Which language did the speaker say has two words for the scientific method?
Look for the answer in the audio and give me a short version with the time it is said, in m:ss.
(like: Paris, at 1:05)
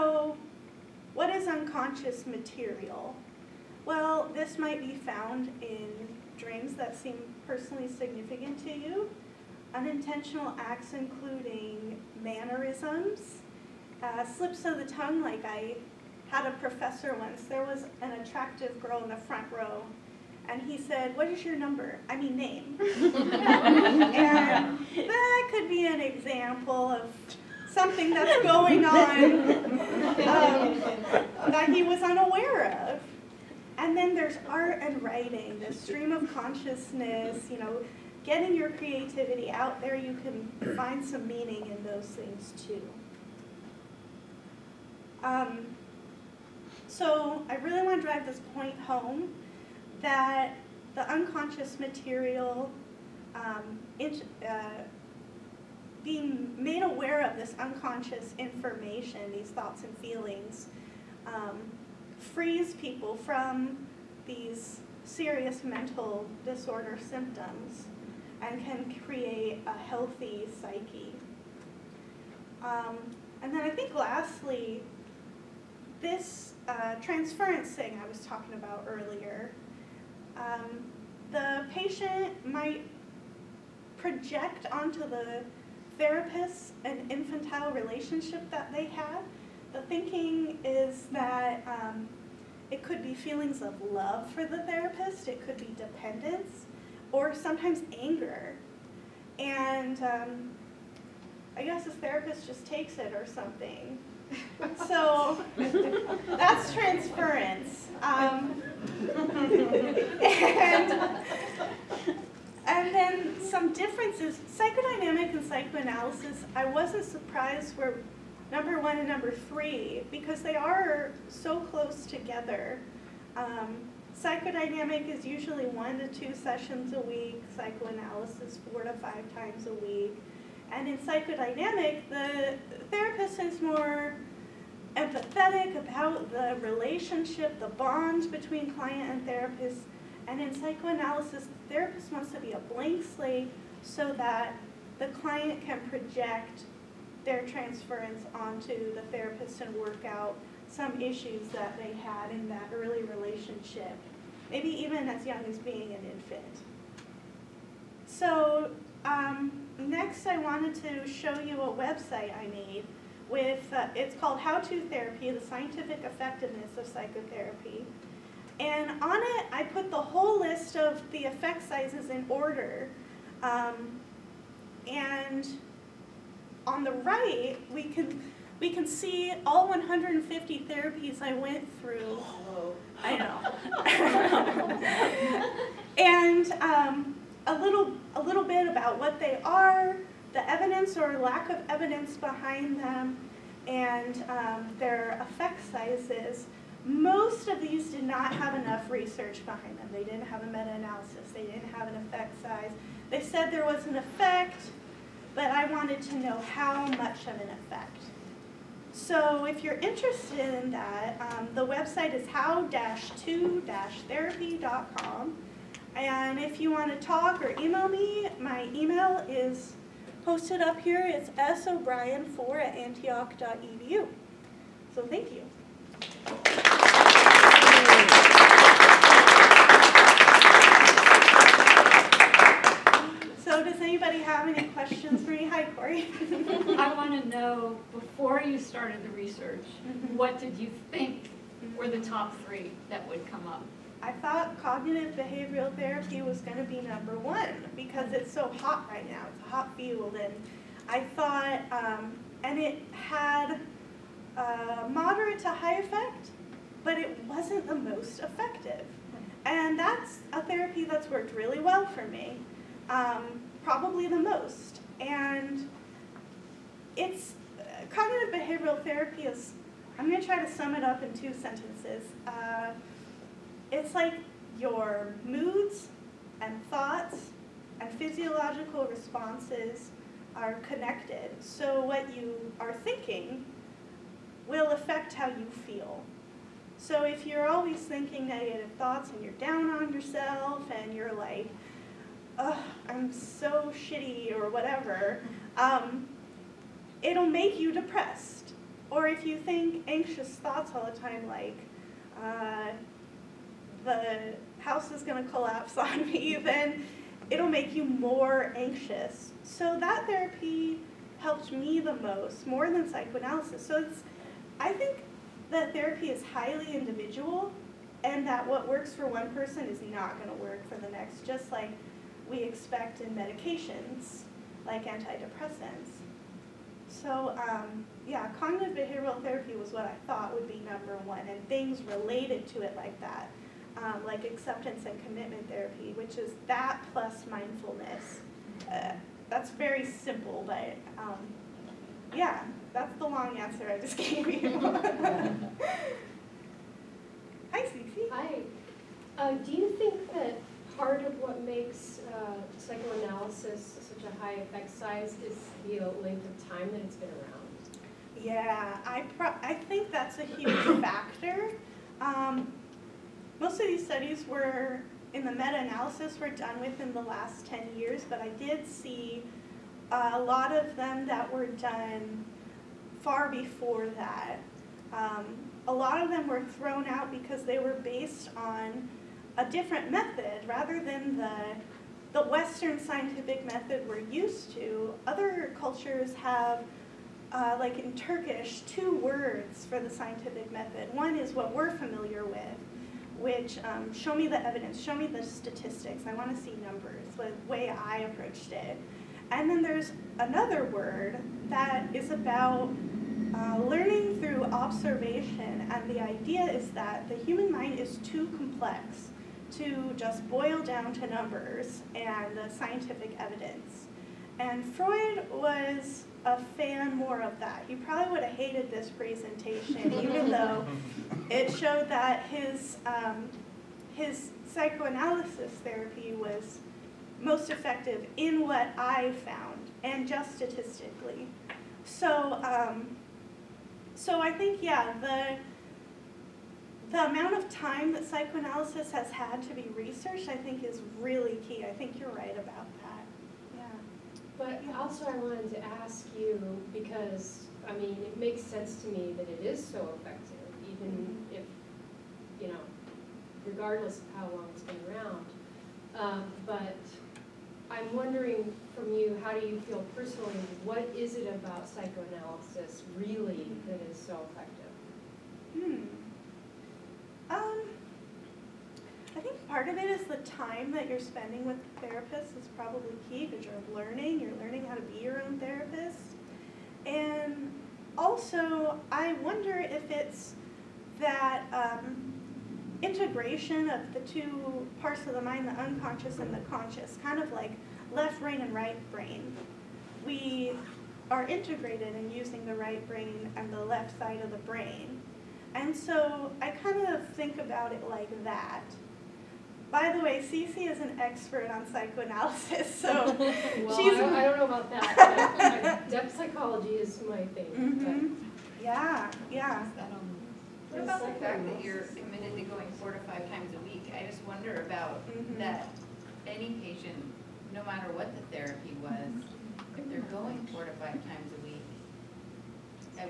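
Turkish, at 6:27.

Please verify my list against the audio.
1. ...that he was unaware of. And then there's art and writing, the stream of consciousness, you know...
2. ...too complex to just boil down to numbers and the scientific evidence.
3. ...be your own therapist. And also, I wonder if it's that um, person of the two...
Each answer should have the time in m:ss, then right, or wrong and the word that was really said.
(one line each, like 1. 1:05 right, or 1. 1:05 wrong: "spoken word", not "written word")
1. 0:31 right
2. 6:47 right
3. 7:54 wrong: "integration", not "person".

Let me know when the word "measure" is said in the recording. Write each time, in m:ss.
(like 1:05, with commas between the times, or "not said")
not said.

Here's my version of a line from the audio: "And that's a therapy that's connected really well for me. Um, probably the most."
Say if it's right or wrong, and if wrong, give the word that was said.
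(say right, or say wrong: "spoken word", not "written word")
wrong: "worked", not "connected".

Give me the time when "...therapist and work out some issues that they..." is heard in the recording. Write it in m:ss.
2:29.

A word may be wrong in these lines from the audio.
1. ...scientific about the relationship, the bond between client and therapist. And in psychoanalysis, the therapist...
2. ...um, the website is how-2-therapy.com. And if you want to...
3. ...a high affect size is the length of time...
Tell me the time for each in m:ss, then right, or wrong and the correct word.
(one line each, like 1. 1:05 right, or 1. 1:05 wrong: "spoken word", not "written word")
1. 2:14 wrong: "empathetic", not "scientific"
2. 3:31 right
3. 5:54 wrong: "effect", not "affect".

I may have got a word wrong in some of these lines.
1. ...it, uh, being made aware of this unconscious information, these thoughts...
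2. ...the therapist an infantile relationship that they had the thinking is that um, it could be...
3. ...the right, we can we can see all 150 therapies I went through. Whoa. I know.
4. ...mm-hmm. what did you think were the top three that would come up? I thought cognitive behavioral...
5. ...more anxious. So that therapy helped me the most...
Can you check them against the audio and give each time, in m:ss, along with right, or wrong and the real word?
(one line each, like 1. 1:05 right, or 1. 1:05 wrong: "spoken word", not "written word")
1. 0:53 right
2. 1:24 right
3. 2:56 right
4. 3:59 right
5. 5:07 right.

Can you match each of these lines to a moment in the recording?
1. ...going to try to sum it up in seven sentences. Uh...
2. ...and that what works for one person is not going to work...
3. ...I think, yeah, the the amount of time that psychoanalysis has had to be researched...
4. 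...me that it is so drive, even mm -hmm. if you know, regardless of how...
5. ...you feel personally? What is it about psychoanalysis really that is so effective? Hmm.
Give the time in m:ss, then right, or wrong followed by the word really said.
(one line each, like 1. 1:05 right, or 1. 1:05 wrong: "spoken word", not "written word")
1. 4:30 wrong: "two", not "seven"
2. 5:18 right
3. 7:14 right
4. 7:28 wrong: "effective", not "drive"
5. 7:39 right.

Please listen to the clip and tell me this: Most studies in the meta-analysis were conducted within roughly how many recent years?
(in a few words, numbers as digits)
10 years.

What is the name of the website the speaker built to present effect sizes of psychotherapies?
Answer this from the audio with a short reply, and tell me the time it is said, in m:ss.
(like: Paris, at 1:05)
How To Therapy, at 2:44.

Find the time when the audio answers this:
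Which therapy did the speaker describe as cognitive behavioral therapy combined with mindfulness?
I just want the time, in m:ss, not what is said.
5:34.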